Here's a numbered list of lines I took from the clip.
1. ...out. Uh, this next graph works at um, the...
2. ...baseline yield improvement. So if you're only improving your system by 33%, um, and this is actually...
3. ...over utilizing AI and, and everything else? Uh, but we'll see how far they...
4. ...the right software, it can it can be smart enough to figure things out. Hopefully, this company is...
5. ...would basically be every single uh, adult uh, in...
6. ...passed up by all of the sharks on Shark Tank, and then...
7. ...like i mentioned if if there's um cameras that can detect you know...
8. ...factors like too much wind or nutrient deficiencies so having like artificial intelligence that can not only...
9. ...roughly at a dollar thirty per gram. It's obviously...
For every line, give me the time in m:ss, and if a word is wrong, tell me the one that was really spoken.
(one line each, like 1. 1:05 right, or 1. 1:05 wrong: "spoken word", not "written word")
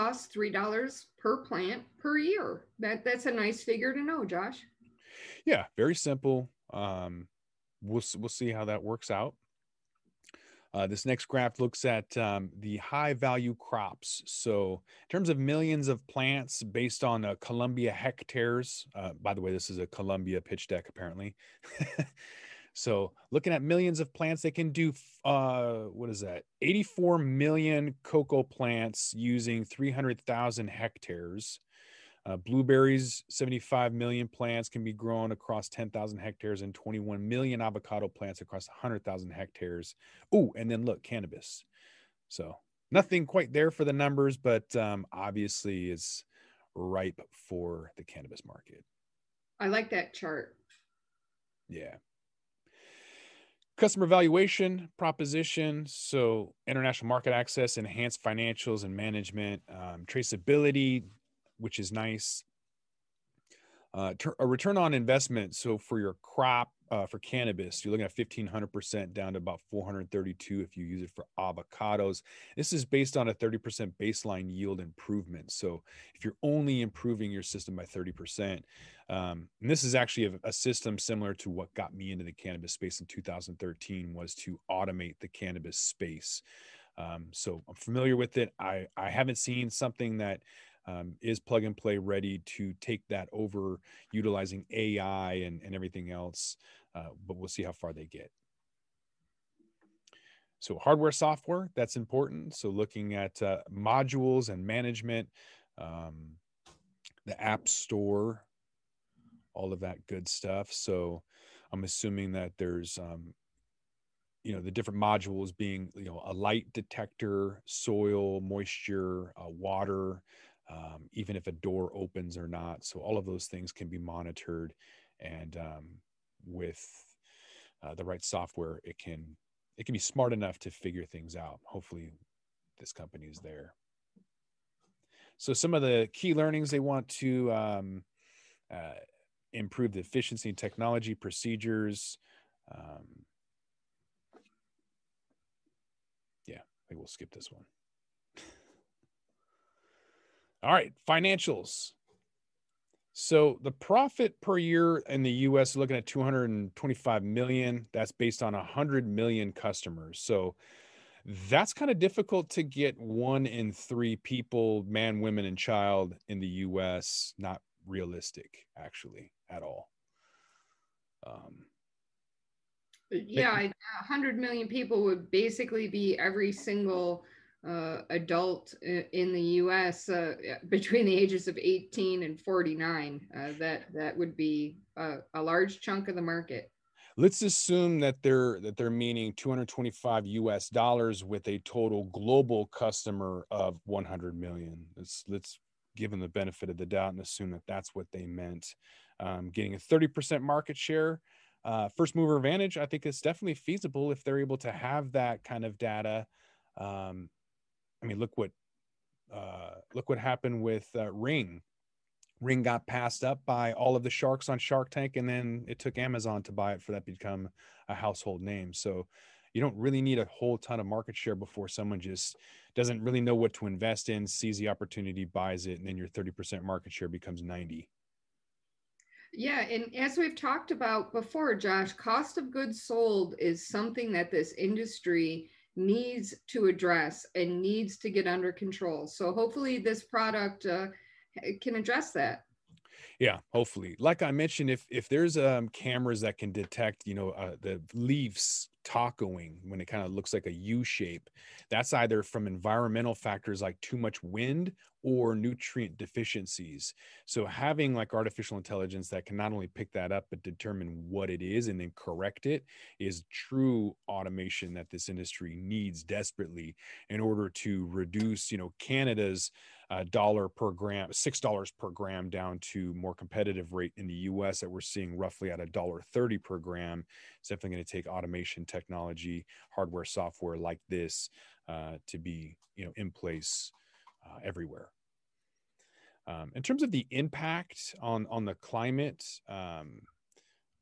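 1. 0:09 wrong: "looks", not "works"
2. 1:13 wrong: "30", not "33"
3. 1:33 right
4. 2:07 right
5. 2:55 right
6. 3:32 right
7. 4:03 right
8. 4:13 right
9. 4:35 wrong: "definitely", not "obviously".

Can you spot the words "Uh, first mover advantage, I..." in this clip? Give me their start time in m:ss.
3:21.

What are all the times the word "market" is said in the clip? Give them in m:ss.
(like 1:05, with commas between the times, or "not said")
0:48, 0:57, 3:06, 3:20, 3:40, 3:46.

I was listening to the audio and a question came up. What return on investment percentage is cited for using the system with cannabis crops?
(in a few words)
1500%.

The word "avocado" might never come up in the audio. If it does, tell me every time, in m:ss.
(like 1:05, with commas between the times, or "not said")
0:37, 1:11.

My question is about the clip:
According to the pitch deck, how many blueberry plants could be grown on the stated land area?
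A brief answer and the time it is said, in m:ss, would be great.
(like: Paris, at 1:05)
75 million, at 0:33.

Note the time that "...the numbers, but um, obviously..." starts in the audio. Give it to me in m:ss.
0:43.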